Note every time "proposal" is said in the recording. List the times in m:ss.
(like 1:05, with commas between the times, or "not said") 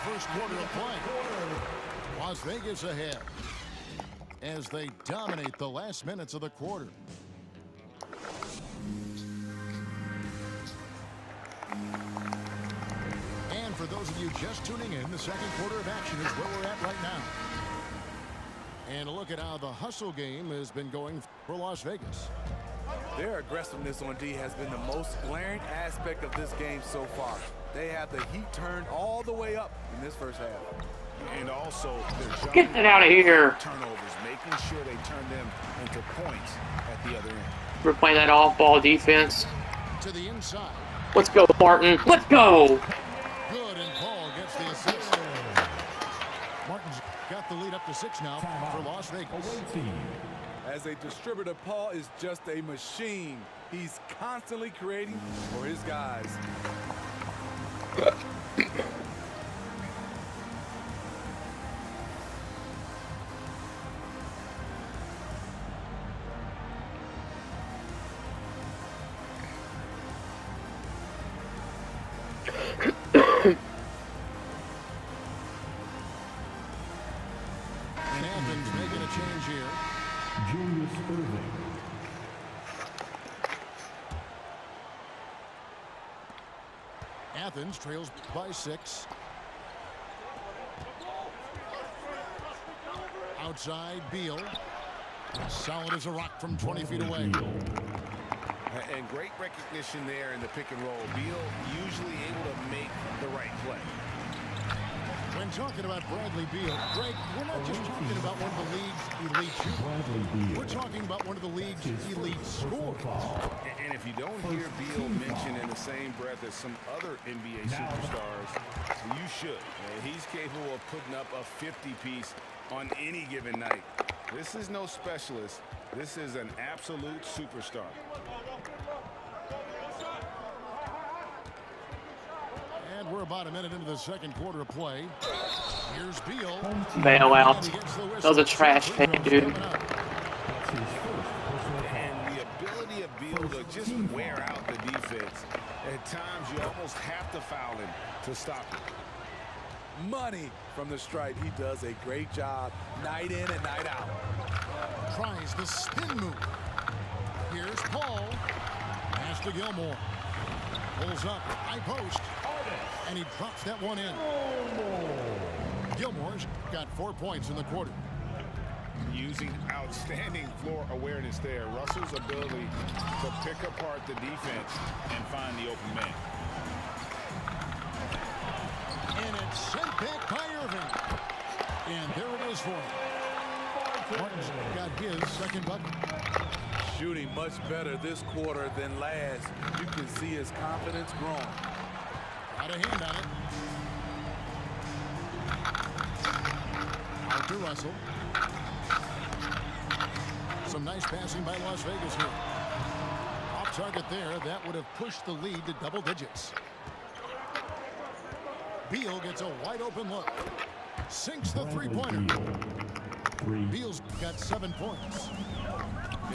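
not said.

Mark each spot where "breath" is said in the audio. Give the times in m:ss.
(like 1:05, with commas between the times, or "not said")
1:56.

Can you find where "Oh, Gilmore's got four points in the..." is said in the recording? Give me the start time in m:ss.
2:44.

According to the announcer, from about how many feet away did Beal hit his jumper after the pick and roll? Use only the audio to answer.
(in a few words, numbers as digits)
20 feet.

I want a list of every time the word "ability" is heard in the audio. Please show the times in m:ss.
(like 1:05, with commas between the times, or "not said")
2:52.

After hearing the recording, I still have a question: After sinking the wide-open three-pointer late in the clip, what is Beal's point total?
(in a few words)
7.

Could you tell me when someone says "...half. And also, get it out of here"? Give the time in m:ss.
0:30.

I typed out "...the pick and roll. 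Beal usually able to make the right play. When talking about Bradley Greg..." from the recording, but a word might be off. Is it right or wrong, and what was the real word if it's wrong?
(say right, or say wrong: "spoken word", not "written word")
wrong: "Beal", not "Greg".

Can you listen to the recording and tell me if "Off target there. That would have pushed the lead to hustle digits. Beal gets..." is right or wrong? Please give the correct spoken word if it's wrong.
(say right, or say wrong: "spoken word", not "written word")
wrong: "double", not "hustle".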